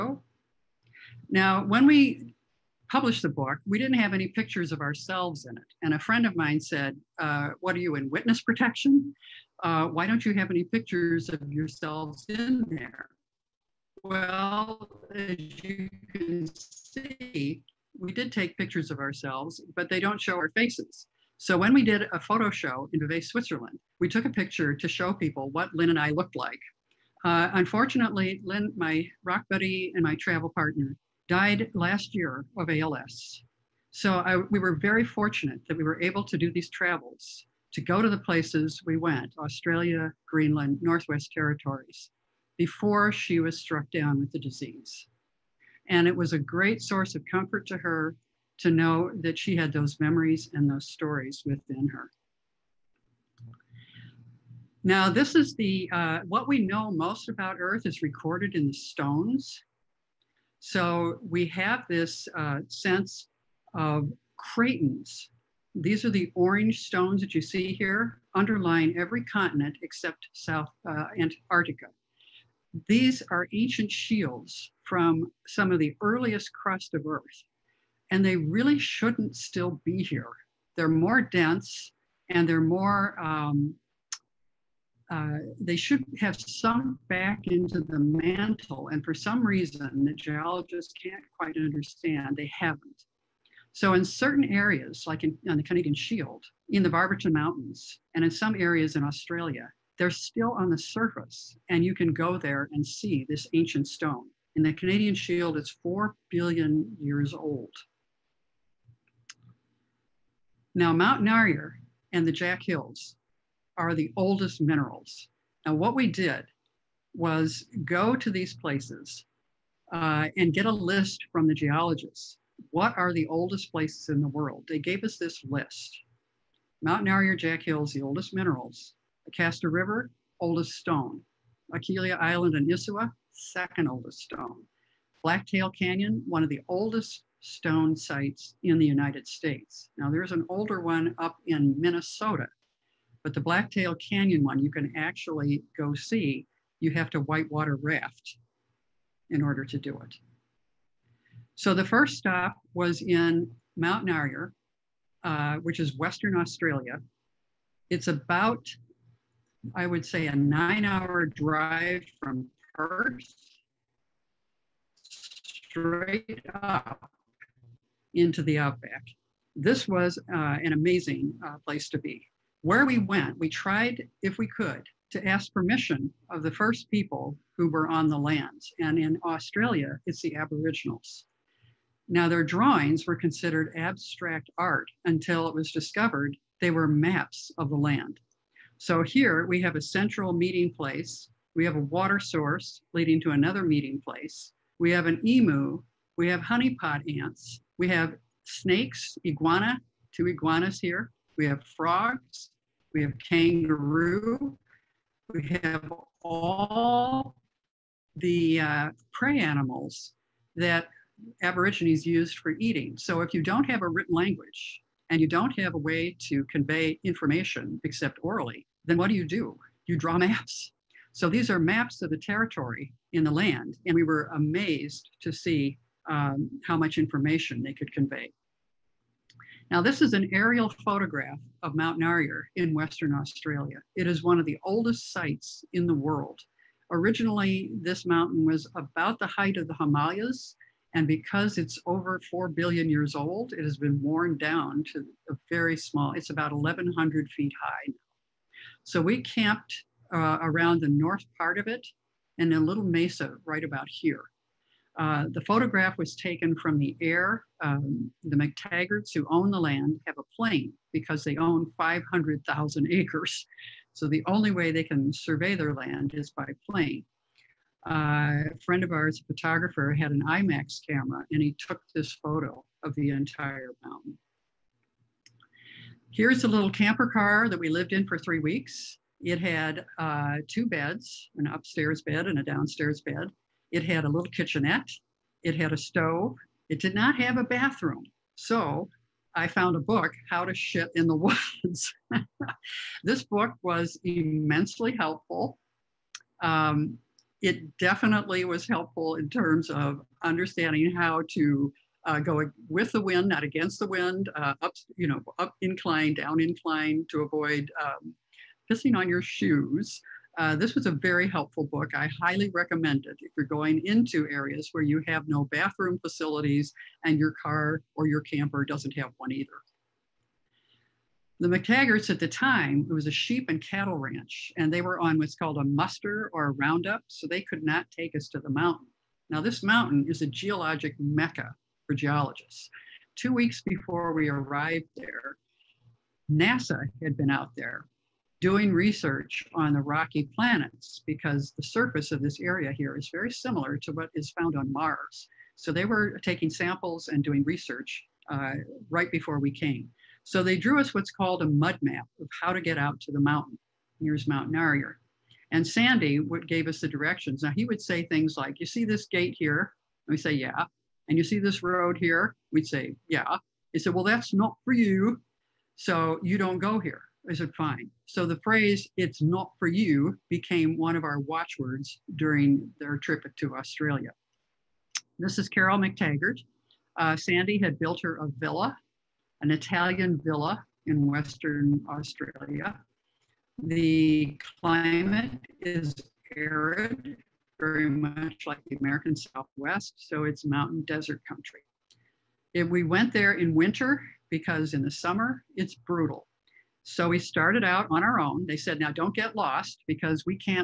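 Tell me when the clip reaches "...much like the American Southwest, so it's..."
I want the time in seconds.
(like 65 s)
387 s.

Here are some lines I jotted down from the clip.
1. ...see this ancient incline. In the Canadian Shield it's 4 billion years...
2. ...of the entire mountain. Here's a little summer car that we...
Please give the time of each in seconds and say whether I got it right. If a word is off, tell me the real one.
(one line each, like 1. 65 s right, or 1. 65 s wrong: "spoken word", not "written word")
1. 102 s wrong: "stone", not "incline"
2. 272 s wrong: "camper", not "summer".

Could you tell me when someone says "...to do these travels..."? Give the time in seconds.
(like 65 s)
36 s.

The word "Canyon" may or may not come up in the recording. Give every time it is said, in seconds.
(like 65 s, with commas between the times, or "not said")
135 s, 143 s.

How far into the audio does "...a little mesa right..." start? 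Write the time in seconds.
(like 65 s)
252 s.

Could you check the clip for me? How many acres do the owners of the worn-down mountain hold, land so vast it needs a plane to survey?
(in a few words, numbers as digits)
500,000 acres.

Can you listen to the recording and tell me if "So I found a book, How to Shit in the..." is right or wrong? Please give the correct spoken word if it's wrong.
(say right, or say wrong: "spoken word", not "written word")
right.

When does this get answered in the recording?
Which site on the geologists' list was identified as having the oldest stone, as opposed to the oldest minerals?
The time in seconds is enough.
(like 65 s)
129 s.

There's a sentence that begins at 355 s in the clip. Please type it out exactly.
And Sandy would, gave us the directions.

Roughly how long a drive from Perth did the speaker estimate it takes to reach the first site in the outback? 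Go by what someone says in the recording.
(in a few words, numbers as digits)
9 hours.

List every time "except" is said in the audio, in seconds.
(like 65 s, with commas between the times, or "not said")
69 s, 217 s.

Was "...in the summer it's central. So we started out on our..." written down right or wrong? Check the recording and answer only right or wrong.
wrong.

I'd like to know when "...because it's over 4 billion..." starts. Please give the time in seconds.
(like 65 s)
241 s.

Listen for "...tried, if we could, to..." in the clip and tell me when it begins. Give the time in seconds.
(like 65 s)
173 s.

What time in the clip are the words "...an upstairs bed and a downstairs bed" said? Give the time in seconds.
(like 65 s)
281 s.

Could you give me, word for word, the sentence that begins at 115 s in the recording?
Now, what we did was go to these places uh, and get a list from the geologists.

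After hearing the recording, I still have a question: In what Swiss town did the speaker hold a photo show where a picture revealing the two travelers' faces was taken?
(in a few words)
Vevey.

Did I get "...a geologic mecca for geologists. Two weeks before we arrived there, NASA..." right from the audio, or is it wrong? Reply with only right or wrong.
right.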